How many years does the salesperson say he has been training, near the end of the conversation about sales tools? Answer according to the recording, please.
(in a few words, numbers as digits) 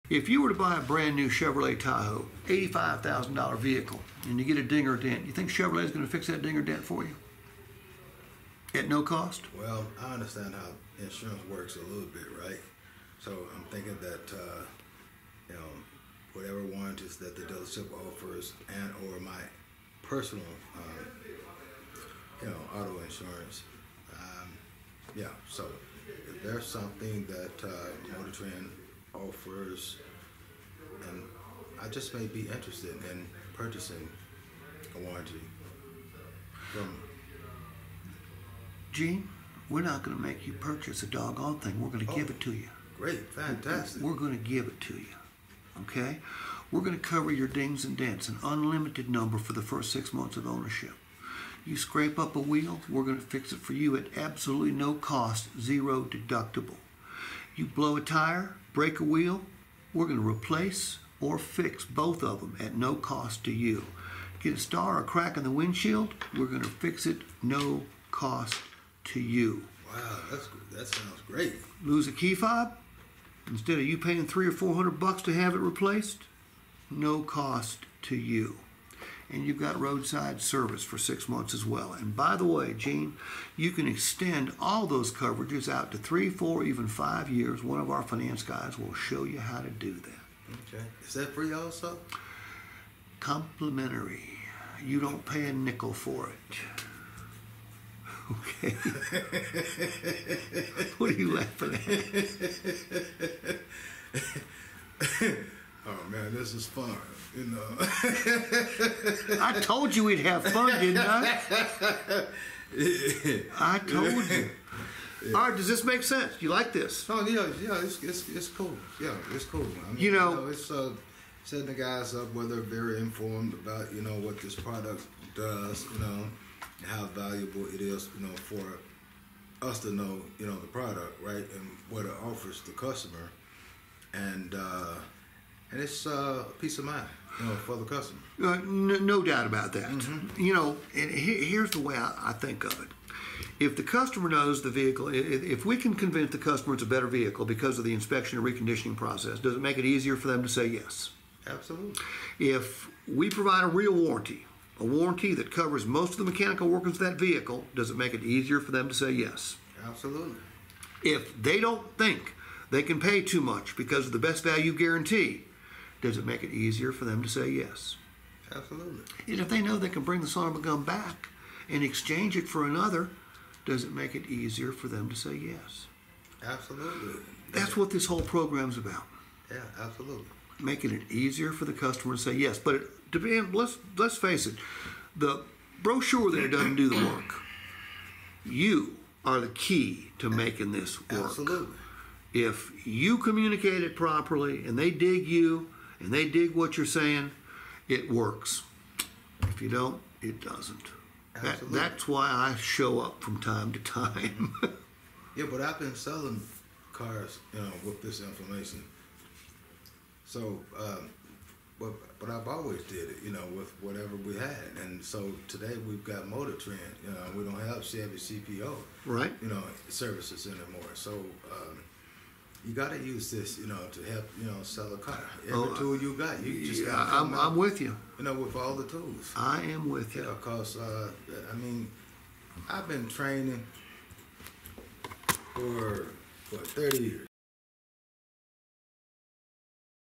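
30.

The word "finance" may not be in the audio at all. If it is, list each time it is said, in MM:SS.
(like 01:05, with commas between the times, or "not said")
01:28.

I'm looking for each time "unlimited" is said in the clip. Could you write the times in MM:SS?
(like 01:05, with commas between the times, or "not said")
00:48.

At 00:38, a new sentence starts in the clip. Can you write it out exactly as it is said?
Gene, we're not going to make you purchase a doggone thing.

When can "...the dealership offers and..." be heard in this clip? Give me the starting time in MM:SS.
00:17.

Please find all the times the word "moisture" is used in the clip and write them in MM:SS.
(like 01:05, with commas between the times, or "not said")
not said.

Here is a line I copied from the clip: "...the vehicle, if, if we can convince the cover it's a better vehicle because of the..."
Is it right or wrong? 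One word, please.
wrong.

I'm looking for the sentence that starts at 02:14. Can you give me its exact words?
Uh, and it's uh, peace of mind you know, for the customer.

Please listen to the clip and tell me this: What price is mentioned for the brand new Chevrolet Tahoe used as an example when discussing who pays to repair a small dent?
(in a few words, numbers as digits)
$85,000.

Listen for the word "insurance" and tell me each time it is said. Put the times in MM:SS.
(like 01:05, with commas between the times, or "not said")
00:11, 00:23.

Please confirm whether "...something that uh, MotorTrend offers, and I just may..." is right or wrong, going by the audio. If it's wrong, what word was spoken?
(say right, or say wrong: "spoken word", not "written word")
right.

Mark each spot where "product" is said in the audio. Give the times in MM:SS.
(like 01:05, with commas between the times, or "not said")
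02:04, 02:10.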